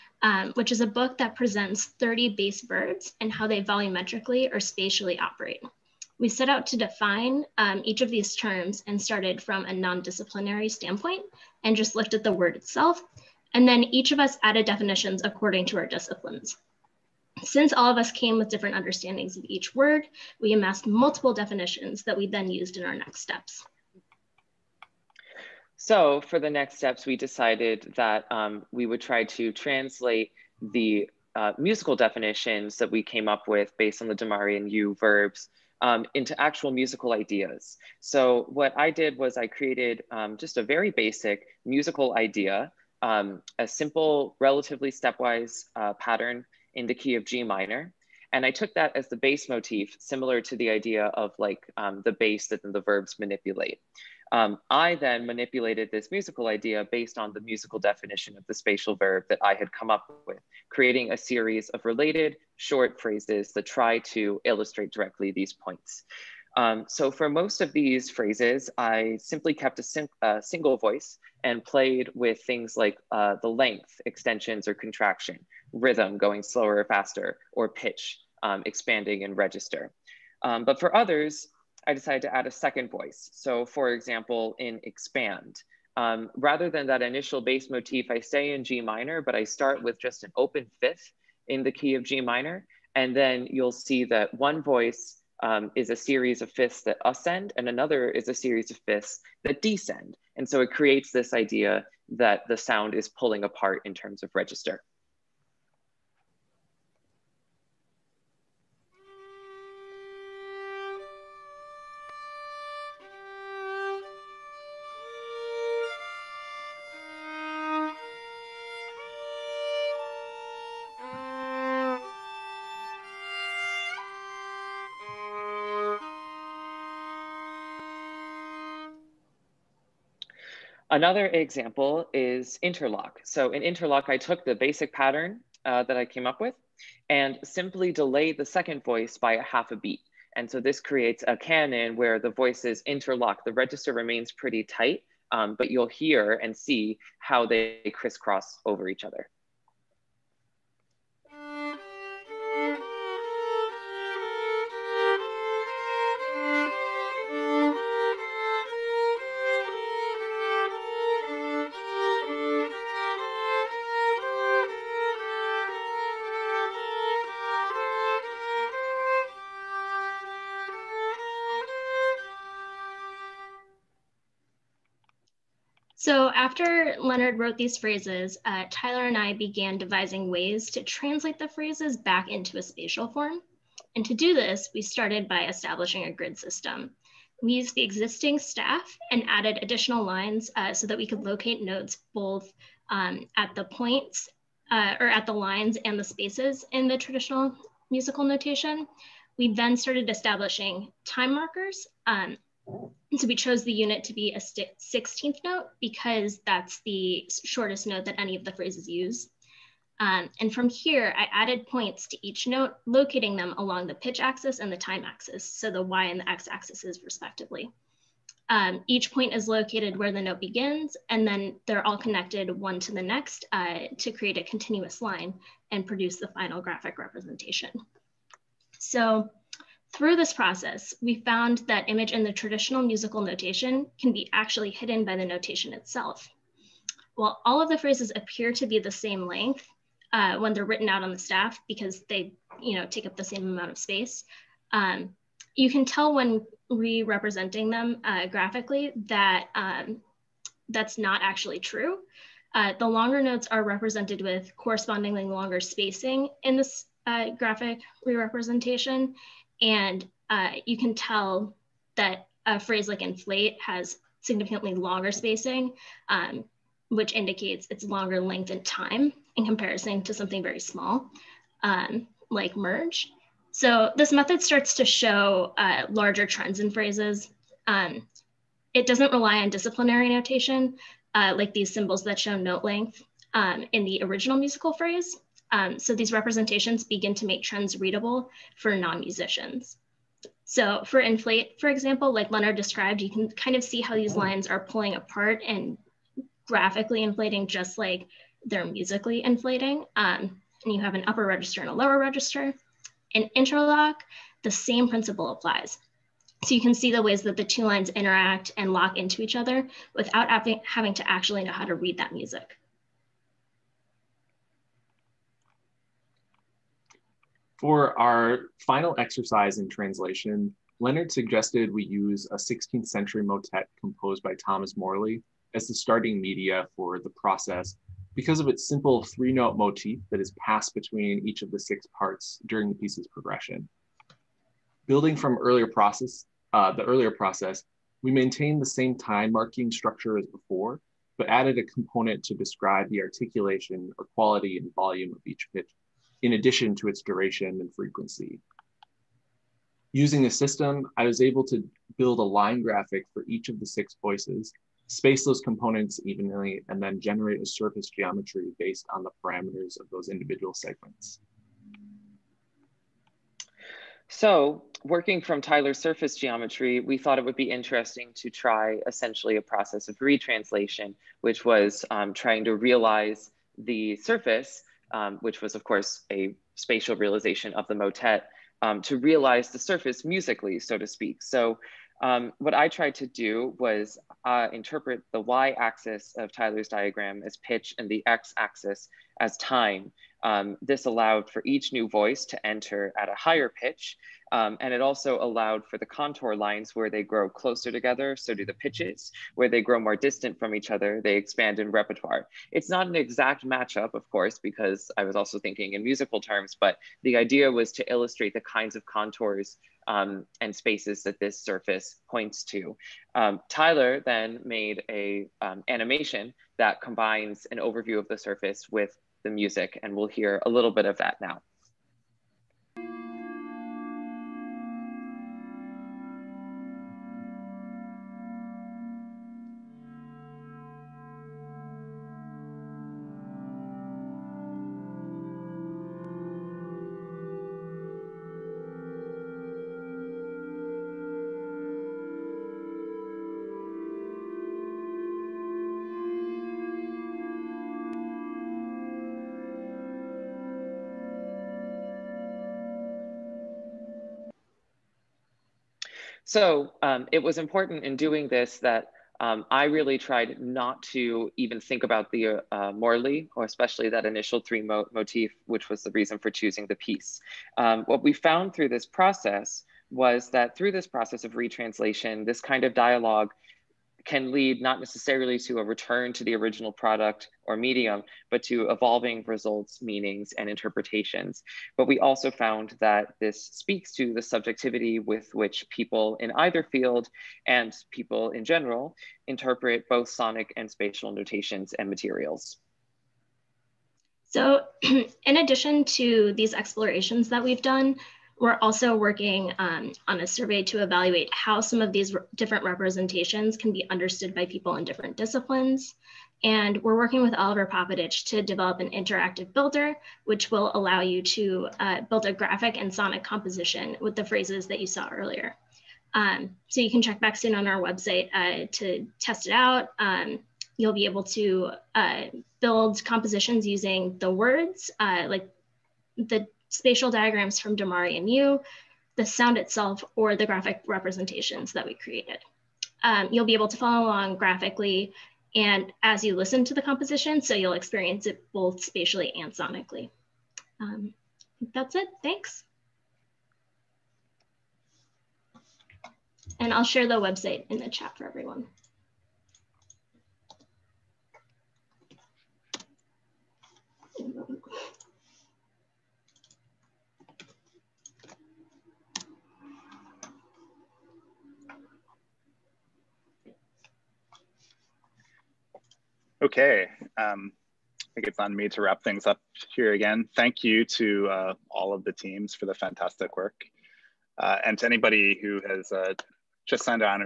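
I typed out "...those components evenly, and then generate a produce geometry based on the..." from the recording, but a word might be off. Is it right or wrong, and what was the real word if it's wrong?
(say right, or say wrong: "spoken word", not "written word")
wrong: "surface", not "produce".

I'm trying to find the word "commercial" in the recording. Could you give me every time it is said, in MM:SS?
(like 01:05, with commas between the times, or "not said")
not said.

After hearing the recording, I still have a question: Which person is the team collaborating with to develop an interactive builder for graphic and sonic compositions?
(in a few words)
Oliver Popovich.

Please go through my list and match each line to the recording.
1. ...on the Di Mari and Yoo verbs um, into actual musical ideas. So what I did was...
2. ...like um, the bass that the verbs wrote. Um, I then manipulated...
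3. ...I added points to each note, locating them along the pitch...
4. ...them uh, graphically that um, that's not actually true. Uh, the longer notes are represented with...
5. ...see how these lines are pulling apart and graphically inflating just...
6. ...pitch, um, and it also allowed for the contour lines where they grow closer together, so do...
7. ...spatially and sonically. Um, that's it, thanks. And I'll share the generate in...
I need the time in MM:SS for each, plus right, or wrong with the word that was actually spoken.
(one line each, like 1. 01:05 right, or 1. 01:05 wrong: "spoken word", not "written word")
1. 00:34 right
2. 00:51 wrong: "manipulate", not "wrote"
3. 03:31 right
4. 04:07 right
5. 04:53 right
6. 06:33 right
7. 08:58 wrong: "website", not "generate".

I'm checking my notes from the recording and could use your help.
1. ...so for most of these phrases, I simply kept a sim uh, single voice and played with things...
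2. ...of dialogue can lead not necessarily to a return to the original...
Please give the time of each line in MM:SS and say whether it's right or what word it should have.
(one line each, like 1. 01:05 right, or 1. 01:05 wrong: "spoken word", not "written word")
1. 01:06 right
2. 07:52 right.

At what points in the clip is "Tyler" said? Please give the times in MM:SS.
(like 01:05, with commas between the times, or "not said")
02:58, 06:05, 06:26, 06:53.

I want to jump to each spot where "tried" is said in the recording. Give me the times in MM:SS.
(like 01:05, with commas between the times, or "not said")
06:22, 07:39.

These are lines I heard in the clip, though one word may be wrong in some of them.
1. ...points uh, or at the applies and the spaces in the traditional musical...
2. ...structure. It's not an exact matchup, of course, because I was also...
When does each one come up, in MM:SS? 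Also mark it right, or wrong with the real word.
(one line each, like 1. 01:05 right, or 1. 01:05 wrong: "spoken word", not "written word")
1. 03:13 wrong: "lines", not "applies"
2. 06:41 wrong: "repertoire", not "structure".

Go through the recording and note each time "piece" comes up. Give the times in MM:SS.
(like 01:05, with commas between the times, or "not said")
05:32, 07:46.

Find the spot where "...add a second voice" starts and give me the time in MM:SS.
01:22.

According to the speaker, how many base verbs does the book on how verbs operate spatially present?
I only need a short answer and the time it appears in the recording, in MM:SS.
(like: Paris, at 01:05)
30, at 00:01.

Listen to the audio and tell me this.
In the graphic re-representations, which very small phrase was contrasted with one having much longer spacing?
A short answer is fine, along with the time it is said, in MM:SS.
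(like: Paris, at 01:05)
merge, at 04:32.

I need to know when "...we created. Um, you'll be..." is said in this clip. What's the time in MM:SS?
08:51.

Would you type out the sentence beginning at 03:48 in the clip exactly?
So through this process, we found that image in the traditional musical notation can be actually hidden by the notation itself.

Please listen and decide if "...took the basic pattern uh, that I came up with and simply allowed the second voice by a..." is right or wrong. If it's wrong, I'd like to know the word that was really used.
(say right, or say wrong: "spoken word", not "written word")
wrong: "delayed", not "allowed".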